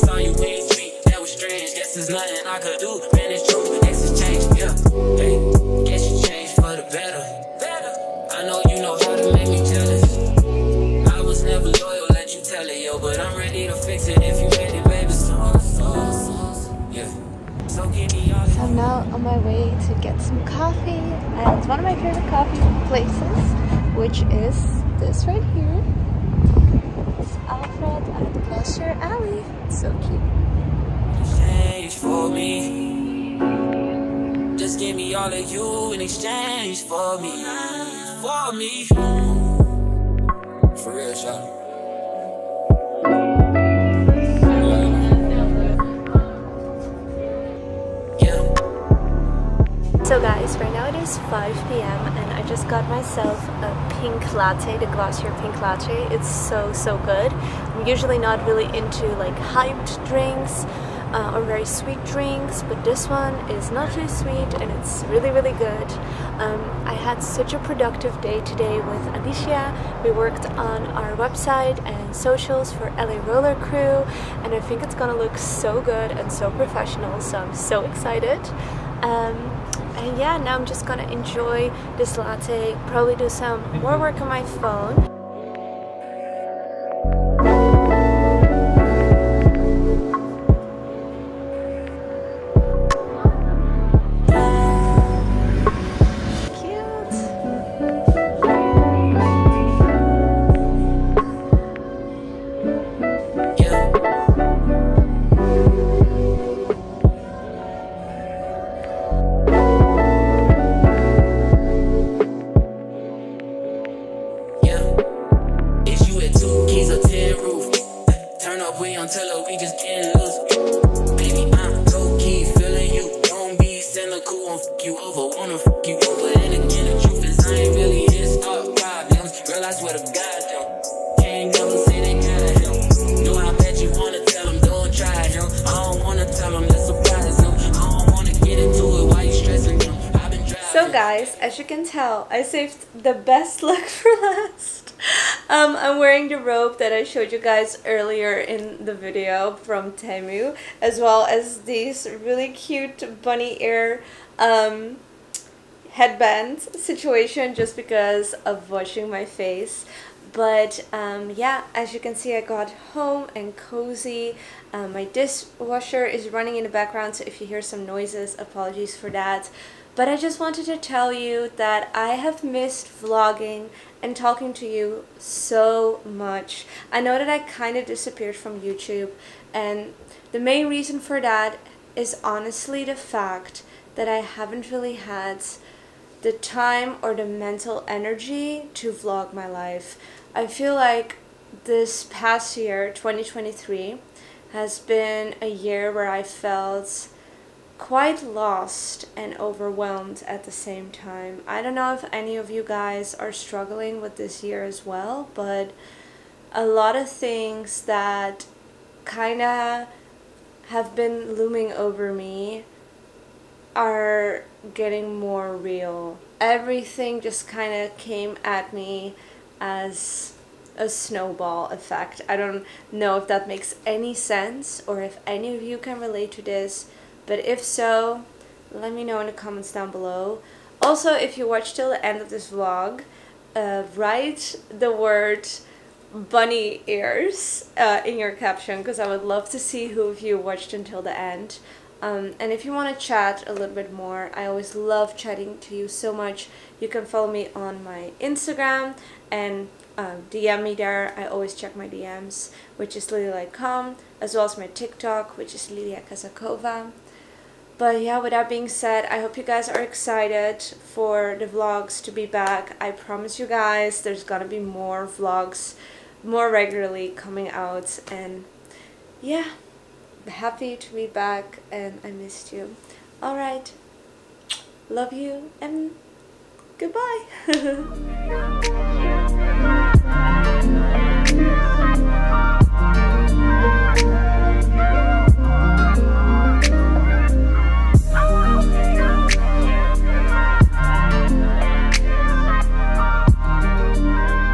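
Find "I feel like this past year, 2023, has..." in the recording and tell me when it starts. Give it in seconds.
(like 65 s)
190 s.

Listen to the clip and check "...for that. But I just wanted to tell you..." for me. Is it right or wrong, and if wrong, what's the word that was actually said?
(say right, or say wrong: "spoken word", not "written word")
right.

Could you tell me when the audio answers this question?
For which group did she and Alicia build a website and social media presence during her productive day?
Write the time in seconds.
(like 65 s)
72 s.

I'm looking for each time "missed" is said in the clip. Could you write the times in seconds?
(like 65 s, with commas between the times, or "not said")
172 s, 272 s.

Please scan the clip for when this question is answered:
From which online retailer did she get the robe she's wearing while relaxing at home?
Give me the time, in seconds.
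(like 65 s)
149 s.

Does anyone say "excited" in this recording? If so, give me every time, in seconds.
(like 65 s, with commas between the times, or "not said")
77 s, 259 s.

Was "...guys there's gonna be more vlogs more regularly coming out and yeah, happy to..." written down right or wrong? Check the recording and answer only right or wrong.
right.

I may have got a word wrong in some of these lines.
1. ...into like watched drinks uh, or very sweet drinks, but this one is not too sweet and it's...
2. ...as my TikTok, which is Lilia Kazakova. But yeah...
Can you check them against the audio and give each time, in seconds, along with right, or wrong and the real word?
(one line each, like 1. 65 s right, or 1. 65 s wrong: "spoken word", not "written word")
1. 58 s wrong: "hyped", not "watched"
2. 254 s right.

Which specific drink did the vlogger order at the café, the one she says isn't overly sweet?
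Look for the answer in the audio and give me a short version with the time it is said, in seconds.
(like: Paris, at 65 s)
glacier pink latte, at 54 s.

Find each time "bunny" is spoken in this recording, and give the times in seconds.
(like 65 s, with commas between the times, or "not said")
153 s, 236 s.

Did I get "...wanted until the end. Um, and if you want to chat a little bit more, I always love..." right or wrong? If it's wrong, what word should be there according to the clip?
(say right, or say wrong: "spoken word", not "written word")
wrong: "watched", not "wanted".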